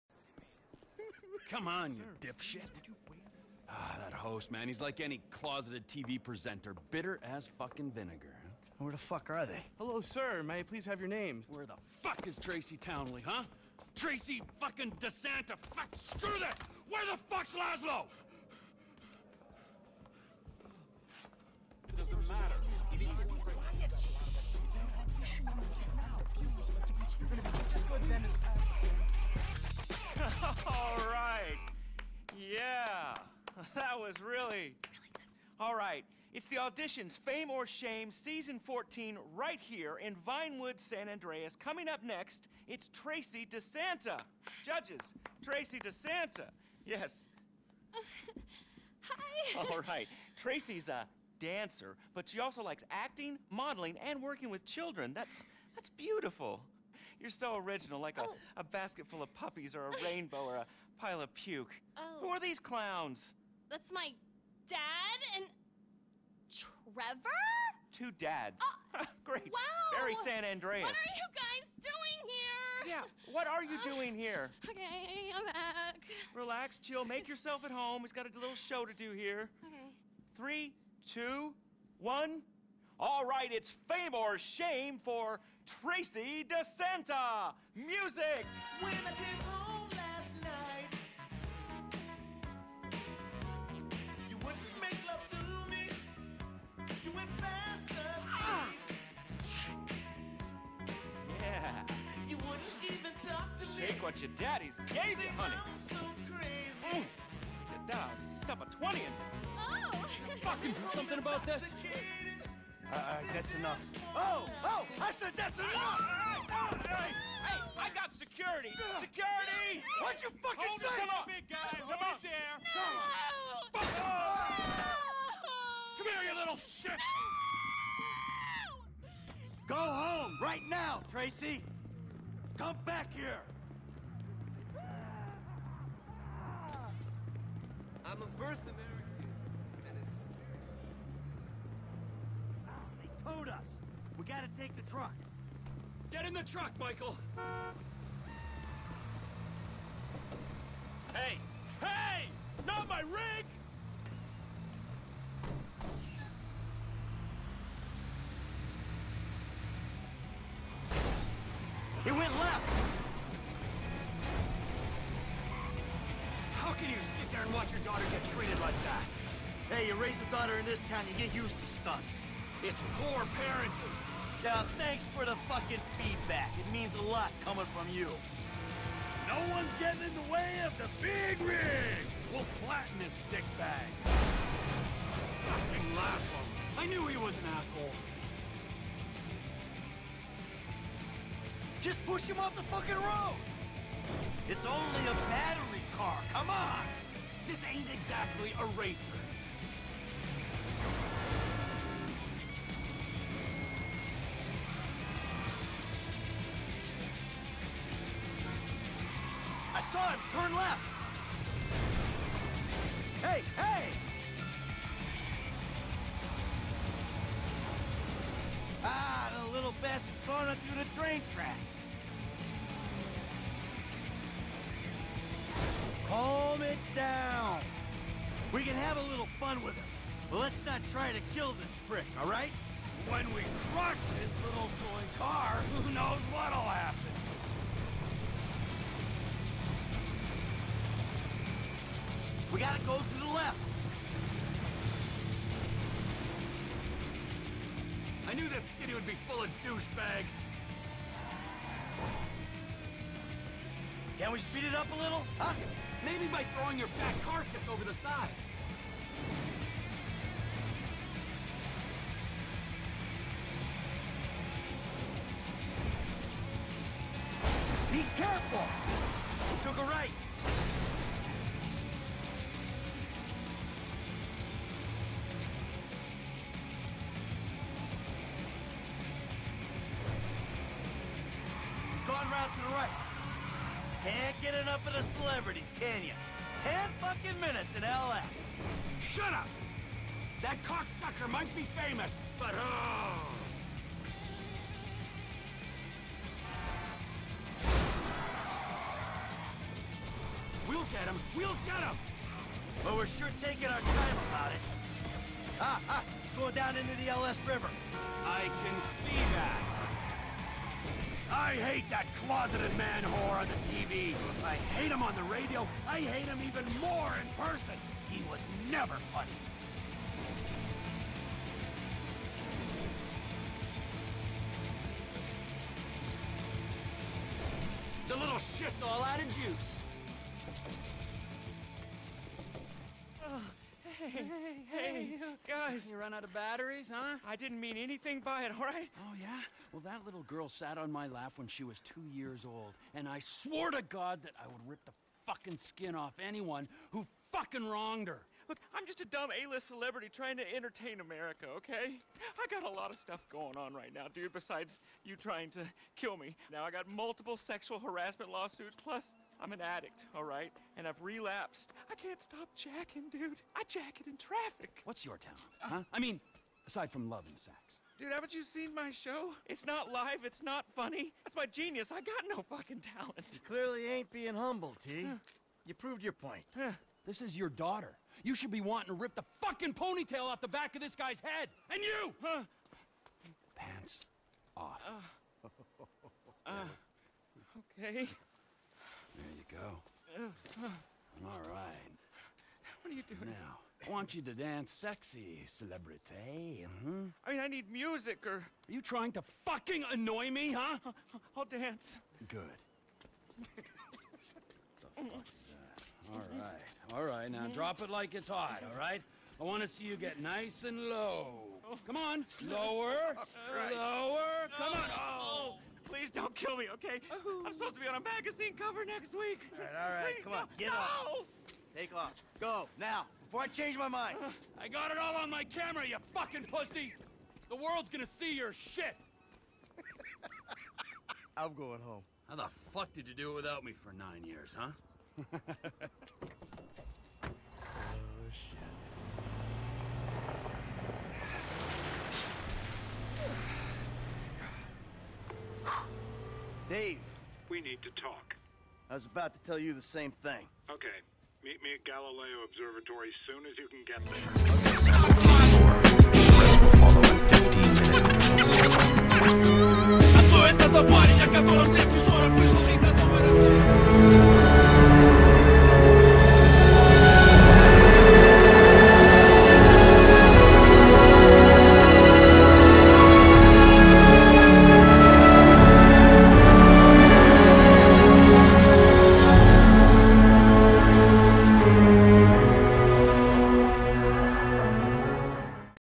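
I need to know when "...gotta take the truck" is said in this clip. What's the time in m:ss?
2:24.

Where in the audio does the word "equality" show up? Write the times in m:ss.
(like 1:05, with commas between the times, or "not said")
not said.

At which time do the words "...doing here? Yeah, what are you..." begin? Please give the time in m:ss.
1:11.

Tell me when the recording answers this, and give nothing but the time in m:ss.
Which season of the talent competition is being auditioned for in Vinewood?
0:38.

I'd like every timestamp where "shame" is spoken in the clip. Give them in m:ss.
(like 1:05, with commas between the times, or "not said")
0:37, 1:24.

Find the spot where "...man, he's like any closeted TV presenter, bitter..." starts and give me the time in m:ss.
0:04.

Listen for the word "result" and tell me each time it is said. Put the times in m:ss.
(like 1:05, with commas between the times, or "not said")
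not said.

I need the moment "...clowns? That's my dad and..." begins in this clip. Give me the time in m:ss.
1:02.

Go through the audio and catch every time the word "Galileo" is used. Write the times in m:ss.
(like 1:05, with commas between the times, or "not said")
7:31.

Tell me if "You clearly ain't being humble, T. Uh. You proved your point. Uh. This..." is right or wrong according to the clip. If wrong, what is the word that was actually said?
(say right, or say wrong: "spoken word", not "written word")
right.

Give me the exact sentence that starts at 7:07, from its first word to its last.
The world's gonna see your shit.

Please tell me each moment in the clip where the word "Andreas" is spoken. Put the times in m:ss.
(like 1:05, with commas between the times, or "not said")
0:41, 1:10.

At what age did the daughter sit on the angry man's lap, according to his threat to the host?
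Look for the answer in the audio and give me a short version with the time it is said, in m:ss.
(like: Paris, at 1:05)
2, at 5:41.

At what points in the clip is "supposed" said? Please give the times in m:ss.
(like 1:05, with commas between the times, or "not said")
6:57.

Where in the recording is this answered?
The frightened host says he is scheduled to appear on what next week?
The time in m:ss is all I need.
6:57.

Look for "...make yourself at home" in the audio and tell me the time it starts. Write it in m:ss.
1:17.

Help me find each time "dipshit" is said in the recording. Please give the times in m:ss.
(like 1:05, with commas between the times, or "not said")
0:02.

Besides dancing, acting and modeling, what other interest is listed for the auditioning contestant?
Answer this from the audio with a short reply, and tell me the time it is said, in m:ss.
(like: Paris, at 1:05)
working with children, at 0:54.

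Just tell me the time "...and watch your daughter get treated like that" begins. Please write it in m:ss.
2:47.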